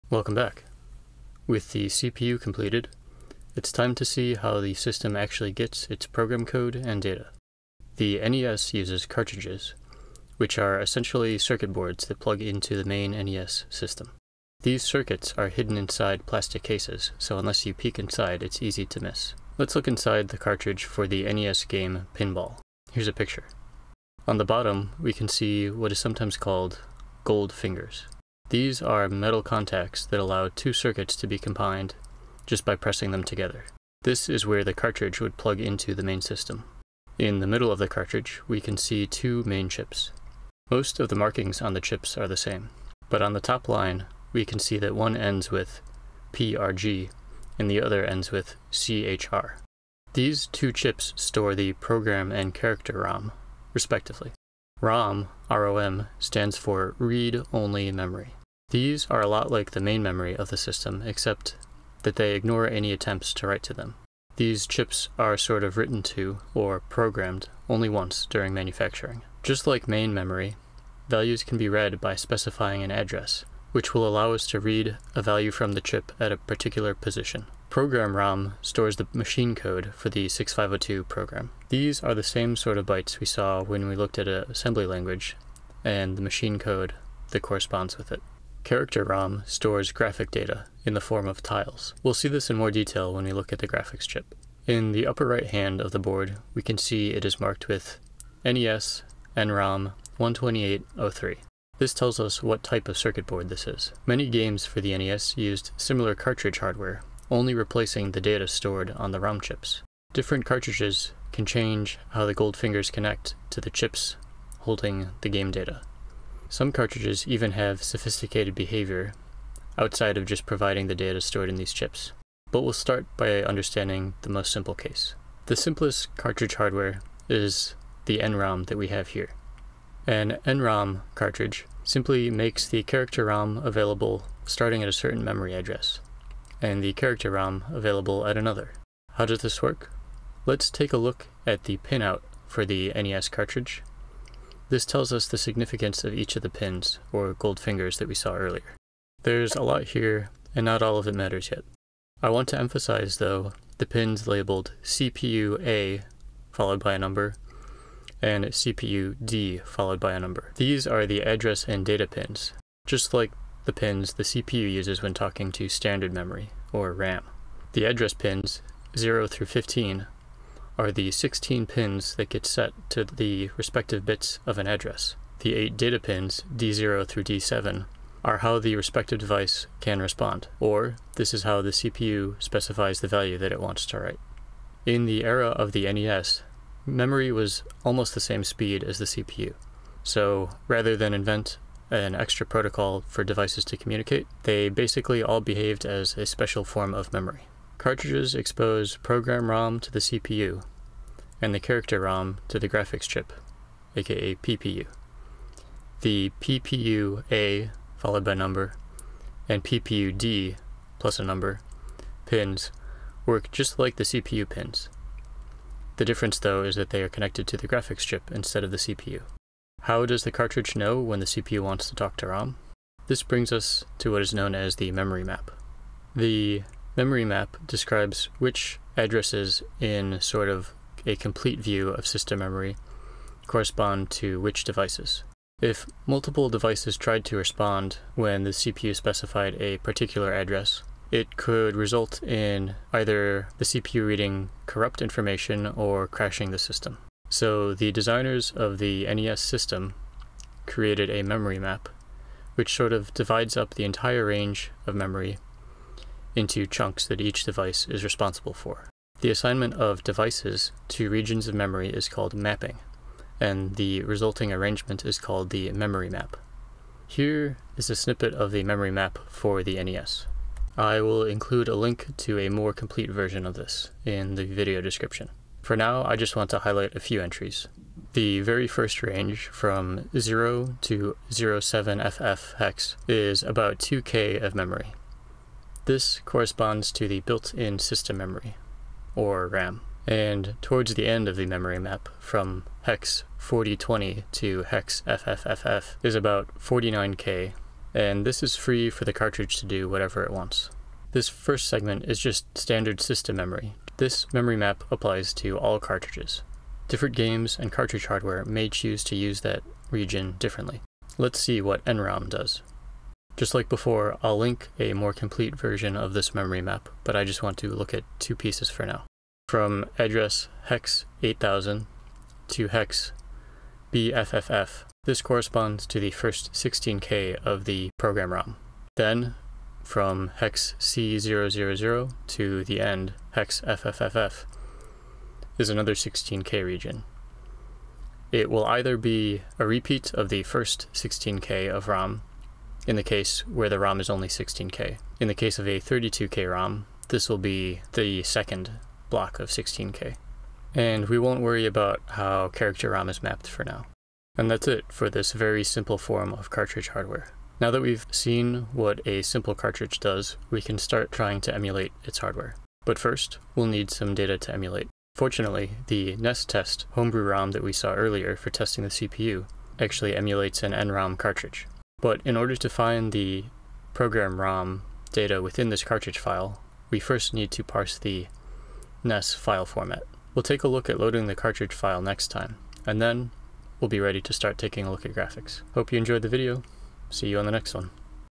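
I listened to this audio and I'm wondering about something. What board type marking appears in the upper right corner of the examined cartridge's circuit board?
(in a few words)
NES NROM 12803.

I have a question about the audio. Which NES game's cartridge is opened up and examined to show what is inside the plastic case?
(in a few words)
Pinball.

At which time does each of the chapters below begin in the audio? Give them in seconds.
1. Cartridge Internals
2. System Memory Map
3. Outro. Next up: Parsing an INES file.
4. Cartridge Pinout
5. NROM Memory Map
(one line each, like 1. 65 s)
1. 24 s
2. 267 s
3. 376 s
4. 144 s
5. 307 s.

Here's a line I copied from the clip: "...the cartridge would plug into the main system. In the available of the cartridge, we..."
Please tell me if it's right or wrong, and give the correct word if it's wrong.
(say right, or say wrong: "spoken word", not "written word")
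wrong: "middle", not "available".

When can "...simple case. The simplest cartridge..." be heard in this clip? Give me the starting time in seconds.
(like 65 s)
124 s.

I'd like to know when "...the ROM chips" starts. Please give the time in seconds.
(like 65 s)
109 s.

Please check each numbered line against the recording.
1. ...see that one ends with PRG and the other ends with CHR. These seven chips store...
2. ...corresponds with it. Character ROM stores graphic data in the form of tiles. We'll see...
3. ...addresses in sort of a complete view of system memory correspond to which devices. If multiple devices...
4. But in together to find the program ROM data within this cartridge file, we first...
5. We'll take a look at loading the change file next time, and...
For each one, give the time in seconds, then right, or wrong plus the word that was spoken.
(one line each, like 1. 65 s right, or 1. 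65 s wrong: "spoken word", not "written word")
1. 44 s wrong: "two", not "seven"
2. 87 s right
3. 228 s right
4. 372 s wrong: "order", not "together"
5. 380 s wrong: "cartridge", not "change".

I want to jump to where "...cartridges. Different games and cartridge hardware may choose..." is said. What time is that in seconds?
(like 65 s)
305 s.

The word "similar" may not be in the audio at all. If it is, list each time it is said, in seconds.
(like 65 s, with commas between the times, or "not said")
105 s.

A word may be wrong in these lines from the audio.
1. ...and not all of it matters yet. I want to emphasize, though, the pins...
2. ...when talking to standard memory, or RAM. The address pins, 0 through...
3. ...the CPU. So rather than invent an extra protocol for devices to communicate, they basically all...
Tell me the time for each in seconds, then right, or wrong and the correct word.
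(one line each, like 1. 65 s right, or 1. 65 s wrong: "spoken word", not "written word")
1. 150 s right
2. 165 s right
3. 188 s right.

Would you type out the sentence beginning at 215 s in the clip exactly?
The difference though is that they are connected to the graphics chip instead of the CPU.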